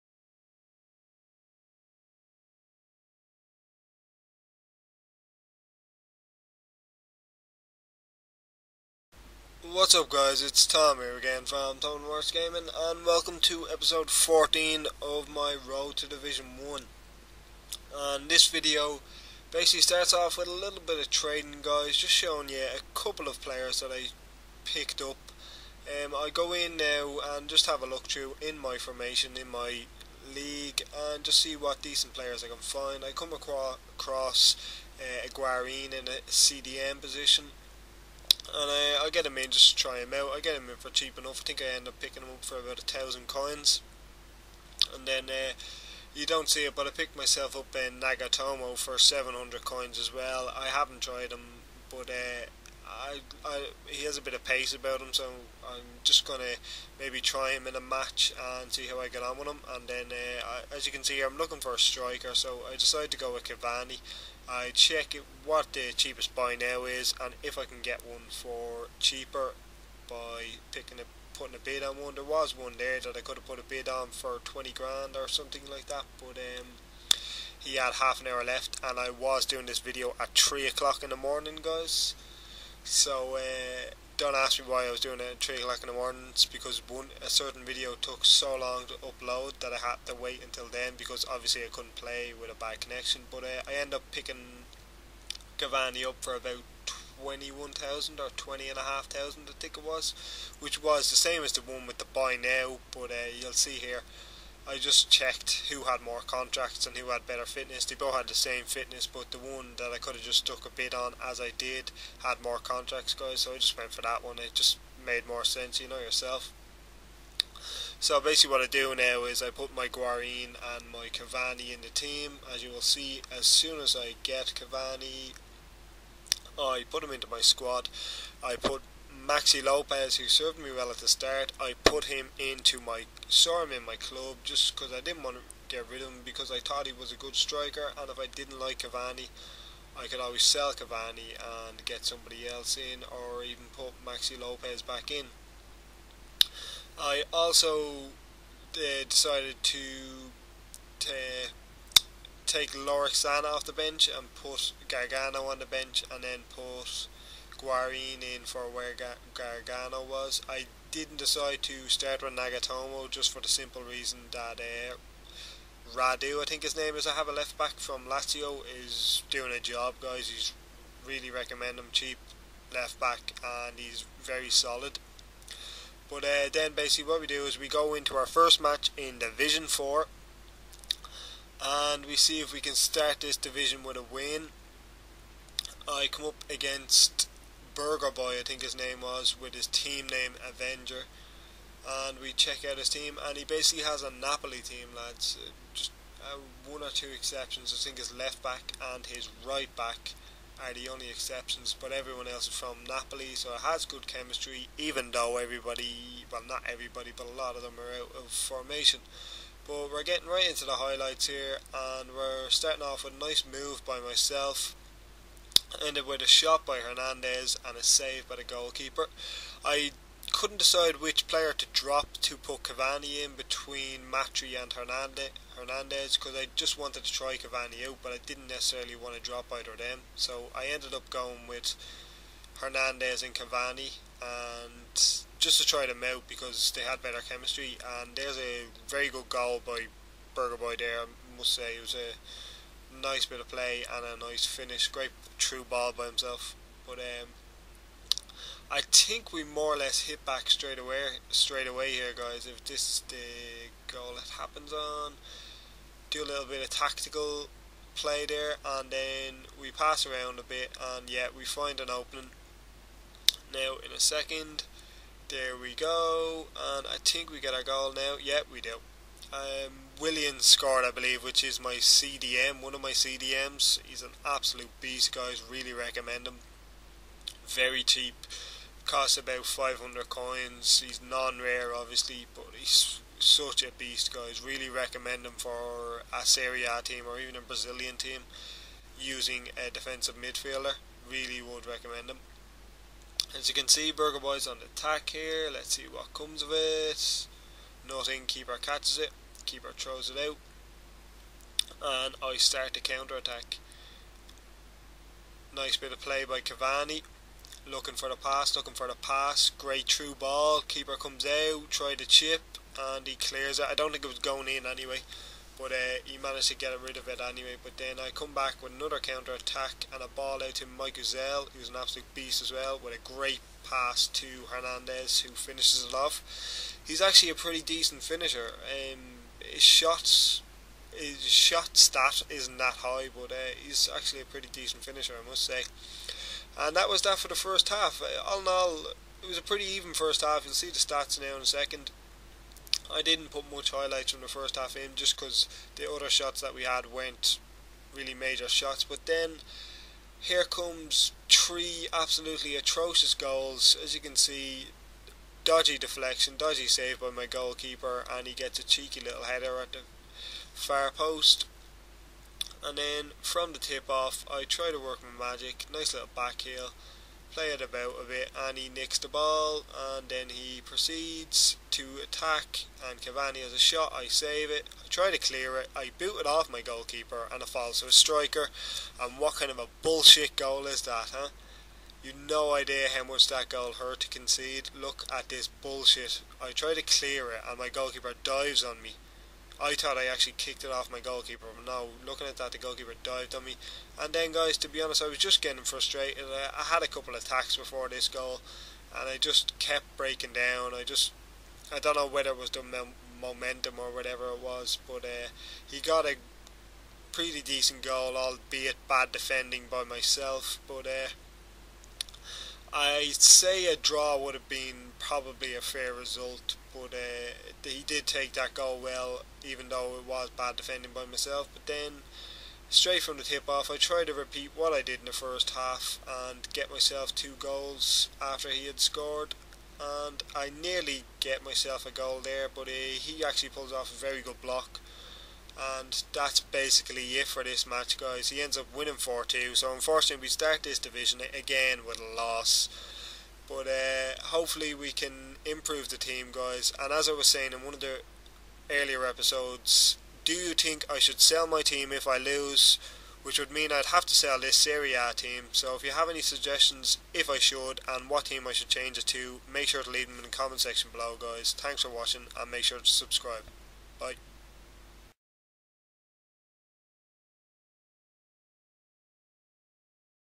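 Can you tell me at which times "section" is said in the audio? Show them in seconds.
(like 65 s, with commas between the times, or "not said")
460 s.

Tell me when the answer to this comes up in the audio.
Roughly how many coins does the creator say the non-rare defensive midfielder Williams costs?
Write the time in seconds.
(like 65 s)
279 s.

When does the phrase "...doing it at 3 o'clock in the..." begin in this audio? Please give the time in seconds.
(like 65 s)
84 s.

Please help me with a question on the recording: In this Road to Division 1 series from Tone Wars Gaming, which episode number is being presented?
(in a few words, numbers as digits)
14.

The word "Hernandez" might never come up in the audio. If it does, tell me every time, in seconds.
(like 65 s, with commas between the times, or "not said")
216 s, 224 s, 232 s, 324 s.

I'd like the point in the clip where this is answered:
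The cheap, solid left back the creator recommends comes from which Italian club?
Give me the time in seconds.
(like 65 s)
168 s.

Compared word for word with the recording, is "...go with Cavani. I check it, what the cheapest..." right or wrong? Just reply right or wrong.
right.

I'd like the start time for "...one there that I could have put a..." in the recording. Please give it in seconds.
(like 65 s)
72 s.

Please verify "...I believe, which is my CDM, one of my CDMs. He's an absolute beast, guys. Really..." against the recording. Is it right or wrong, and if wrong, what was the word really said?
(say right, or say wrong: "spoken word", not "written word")
right.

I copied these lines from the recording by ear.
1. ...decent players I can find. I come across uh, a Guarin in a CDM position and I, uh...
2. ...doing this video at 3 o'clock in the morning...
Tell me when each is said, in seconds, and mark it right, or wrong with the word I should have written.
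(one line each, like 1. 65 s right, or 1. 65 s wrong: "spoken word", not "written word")
1. 31 s right
2. 79 s right.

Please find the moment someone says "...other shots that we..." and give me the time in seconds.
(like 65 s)
345 s.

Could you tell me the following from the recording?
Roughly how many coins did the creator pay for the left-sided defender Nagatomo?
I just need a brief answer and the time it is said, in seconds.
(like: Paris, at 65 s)
700, at 48 s.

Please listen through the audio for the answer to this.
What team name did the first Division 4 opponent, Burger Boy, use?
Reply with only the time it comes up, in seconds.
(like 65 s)
190 s.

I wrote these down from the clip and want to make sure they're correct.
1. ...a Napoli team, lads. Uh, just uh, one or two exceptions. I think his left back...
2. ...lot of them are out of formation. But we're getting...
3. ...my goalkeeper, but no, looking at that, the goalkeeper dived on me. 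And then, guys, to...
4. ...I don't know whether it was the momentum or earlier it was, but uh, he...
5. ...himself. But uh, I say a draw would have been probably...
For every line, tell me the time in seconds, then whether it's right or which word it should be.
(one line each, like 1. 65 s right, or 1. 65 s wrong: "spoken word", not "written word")
1. 194 s right
2. 207 s right
3. 390 s right
4. 401 s wrong: "whatever", not "earlier"
5. 409 s wrong: "myself", not "himself".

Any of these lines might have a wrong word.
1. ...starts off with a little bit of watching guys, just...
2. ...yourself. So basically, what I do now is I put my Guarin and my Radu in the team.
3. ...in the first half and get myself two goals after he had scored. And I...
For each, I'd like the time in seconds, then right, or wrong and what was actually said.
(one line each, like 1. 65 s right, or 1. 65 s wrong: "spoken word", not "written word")
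1. 19 s wrong: "trading", not "watching"
2. 115 s wrong: "Cavani", not "Radu"
3. 424 s right.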